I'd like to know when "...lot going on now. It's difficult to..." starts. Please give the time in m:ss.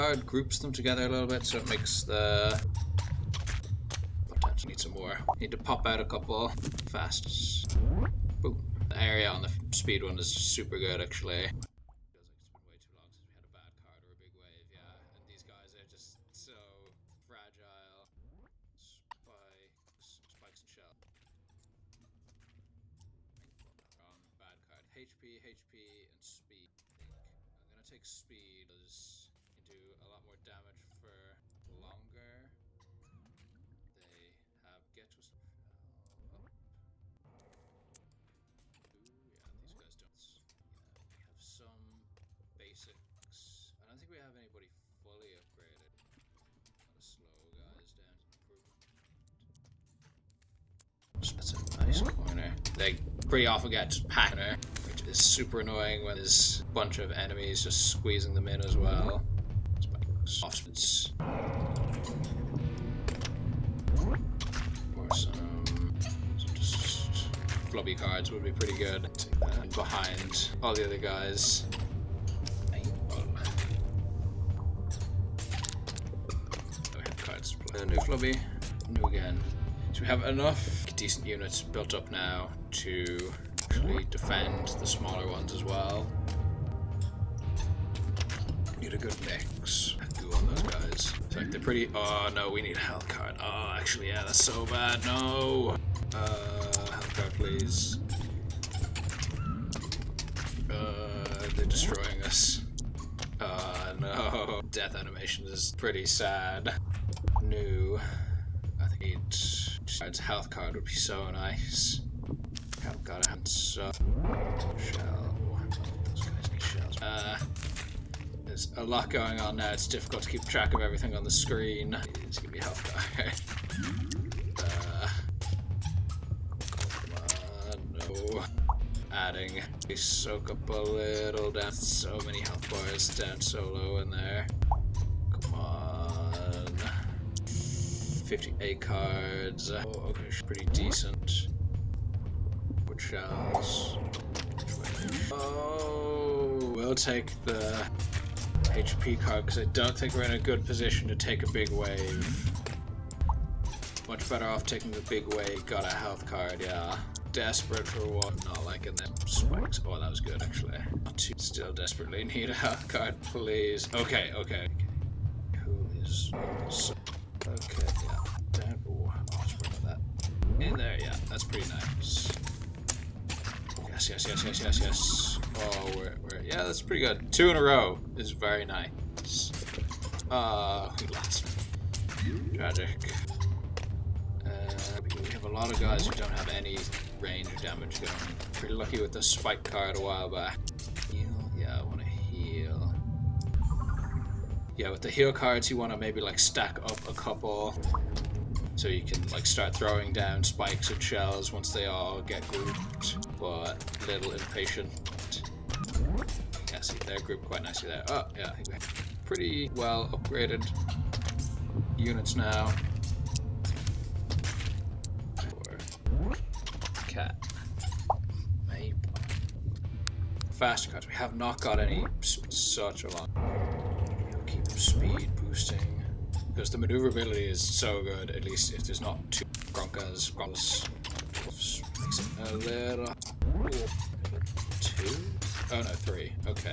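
1:58.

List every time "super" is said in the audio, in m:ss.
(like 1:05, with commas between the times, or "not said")
0:10, 0:55.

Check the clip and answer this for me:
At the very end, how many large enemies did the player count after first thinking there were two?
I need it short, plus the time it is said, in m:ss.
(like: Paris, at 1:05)
3, at 3:56.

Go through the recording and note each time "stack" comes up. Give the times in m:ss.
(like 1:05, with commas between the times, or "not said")
3:16.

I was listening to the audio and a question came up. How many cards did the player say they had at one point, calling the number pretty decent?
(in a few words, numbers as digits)
58.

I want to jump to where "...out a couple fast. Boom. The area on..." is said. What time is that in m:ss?
0:05.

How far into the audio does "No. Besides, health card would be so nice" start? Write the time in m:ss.
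1:47.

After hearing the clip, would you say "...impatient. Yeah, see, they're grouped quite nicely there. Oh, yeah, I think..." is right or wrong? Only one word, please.
right.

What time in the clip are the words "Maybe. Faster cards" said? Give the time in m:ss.
3:38.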